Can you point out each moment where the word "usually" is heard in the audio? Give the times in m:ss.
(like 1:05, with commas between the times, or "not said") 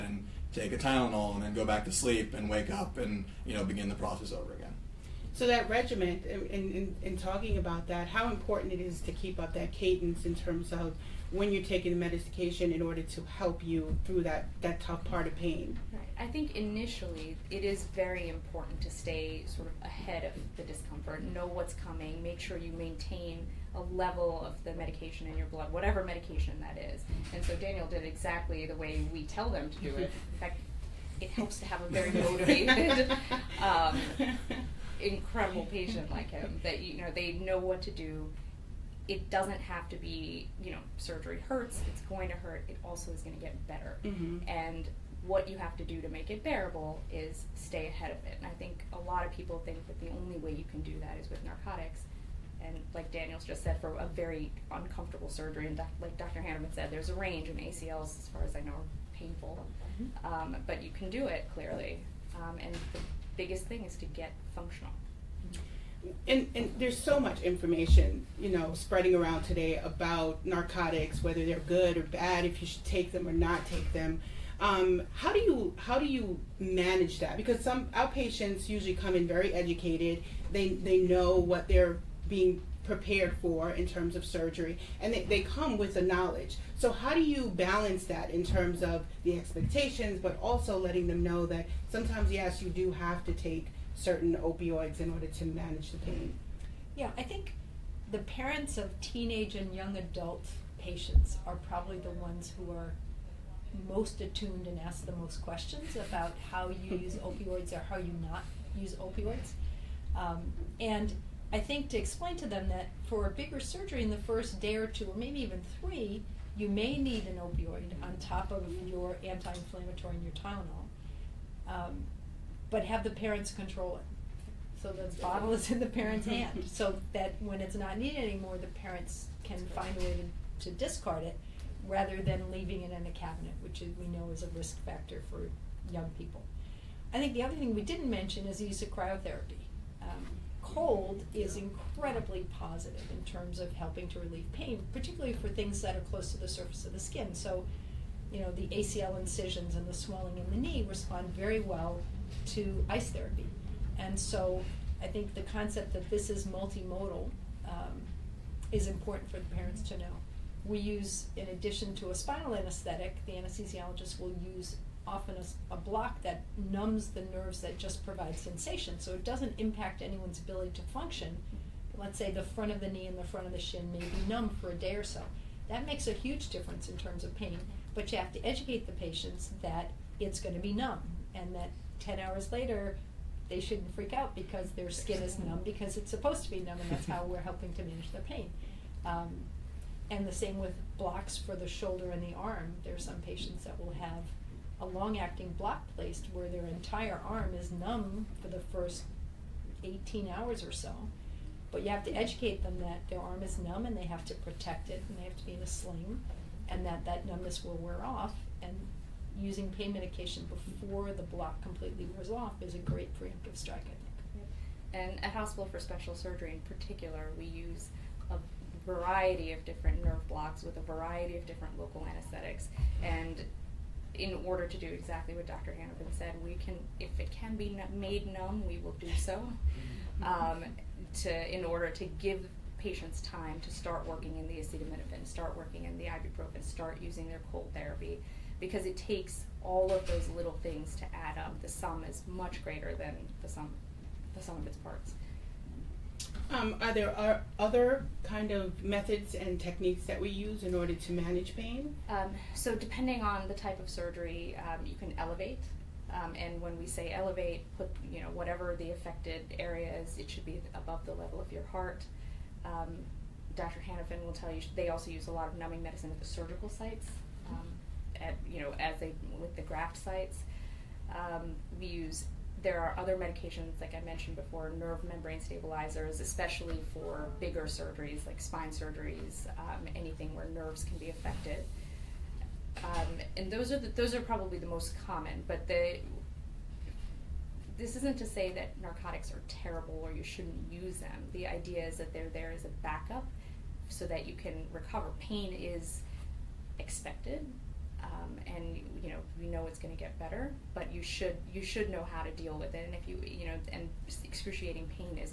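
1:18.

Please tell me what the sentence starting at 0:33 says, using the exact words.
Um, incredible patient like him that you know they know what to do.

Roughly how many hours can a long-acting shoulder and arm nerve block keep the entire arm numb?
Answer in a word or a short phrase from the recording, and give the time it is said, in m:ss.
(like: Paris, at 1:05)
18 hours, at 3:19.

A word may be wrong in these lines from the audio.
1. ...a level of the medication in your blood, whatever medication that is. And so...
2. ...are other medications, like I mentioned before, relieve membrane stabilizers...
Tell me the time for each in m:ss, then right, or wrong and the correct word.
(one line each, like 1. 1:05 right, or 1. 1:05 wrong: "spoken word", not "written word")
1. 0:23 right
2. 4:32 wrong: "nerve", not "relieve".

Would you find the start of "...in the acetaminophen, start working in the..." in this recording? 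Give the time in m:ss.
3:54.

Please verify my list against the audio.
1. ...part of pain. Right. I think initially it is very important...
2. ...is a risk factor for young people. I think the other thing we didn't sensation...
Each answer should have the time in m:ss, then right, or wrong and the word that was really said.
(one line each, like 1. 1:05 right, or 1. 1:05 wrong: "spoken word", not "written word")
1. 0:15 right
2. 2:14 wrong: "mention", not "sensation".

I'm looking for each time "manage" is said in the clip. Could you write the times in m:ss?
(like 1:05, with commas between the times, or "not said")
1:16, 1:35, 3:07, 4:11.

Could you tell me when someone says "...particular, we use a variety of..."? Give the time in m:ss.
3:36.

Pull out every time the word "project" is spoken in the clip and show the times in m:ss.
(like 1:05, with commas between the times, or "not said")
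not said.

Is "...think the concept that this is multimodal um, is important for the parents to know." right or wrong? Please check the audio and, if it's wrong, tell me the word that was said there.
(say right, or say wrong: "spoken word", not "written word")
right.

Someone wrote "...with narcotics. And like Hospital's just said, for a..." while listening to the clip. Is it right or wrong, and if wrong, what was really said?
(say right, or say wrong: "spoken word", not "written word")
wrong: "Daniel", not "Hospital".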